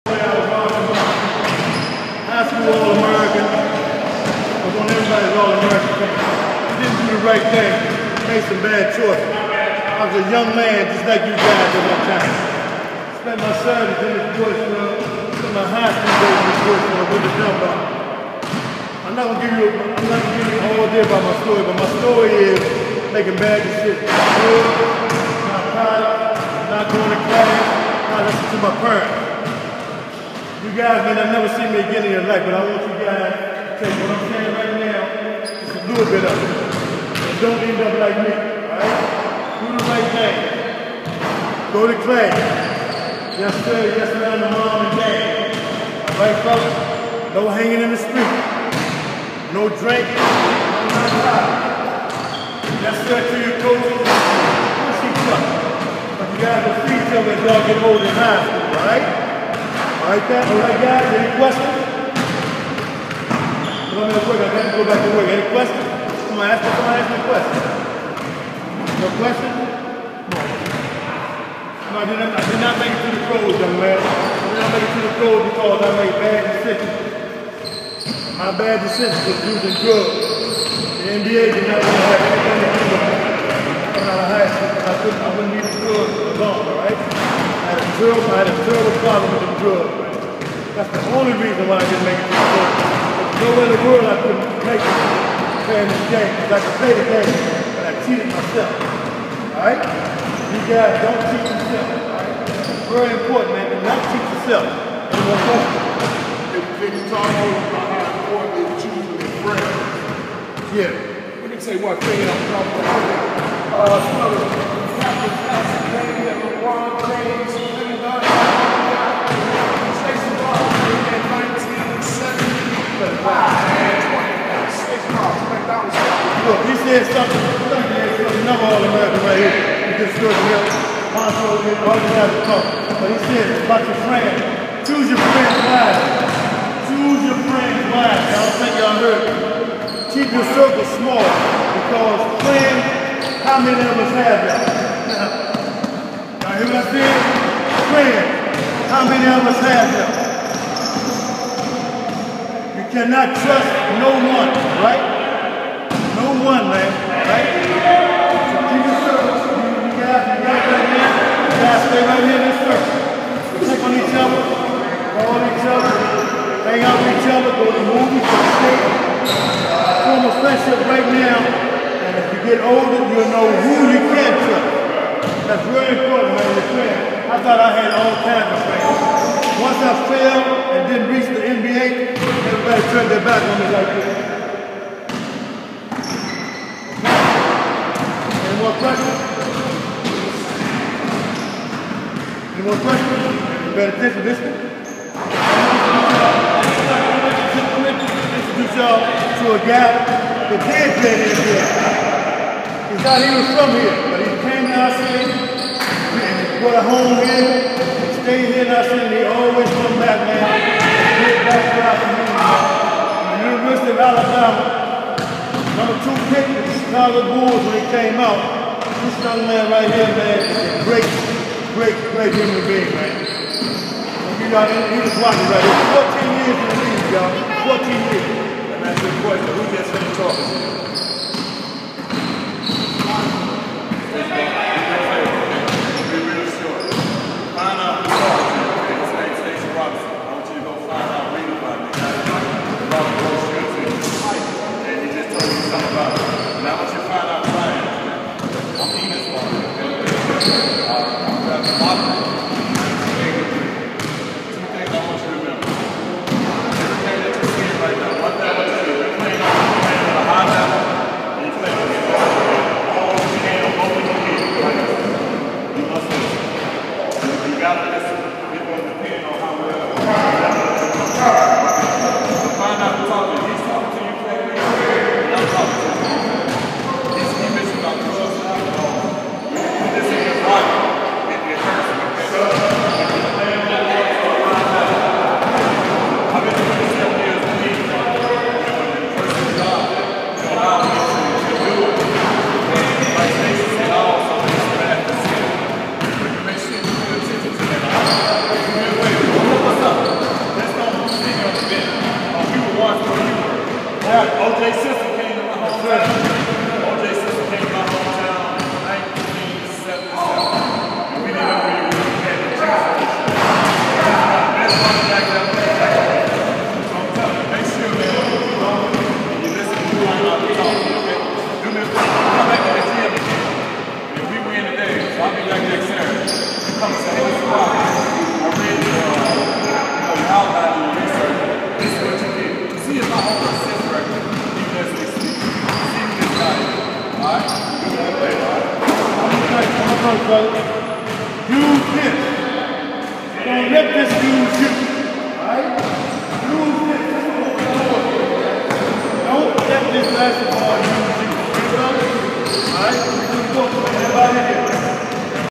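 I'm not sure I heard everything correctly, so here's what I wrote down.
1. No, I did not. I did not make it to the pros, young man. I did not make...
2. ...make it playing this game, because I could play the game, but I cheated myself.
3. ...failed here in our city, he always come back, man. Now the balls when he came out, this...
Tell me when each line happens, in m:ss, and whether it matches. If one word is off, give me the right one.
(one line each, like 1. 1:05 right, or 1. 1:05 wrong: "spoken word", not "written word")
1. 1:10 right
2. 1:34 right
3. 3:28 wrong: "stayed", not "failed".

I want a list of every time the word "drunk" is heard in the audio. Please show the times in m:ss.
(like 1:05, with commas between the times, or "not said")
not said.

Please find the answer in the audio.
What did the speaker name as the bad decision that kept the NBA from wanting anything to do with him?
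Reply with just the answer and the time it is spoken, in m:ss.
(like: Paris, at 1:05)
using drugs, at 1:19.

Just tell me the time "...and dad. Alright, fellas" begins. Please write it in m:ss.
0:44.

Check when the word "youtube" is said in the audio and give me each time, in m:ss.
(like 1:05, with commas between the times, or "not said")
not said.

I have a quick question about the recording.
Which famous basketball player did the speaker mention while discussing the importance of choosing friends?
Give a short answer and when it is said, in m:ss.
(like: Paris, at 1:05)
LeBron James, at 1:56.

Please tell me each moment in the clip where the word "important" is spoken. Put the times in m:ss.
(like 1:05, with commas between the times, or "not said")
1:43, 1:48, 2:55.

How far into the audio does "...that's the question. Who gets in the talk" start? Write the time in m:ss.
3:48.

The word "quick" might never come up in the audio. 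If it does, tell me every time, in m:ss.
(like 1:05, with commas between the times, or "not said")
1:04.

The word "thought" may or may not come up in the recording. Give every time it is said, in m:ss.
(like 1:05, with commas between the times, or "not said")
2:57, 3:23.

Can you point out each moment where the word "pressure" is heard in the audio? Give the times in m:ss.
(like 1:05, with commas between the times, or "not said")
3:08, 3:12.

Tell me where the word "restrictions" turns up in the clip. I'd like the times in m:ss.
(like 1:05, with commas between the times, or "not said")
not said.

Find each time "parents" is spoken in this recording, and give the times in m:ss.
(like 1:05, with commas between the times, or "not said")
0:28.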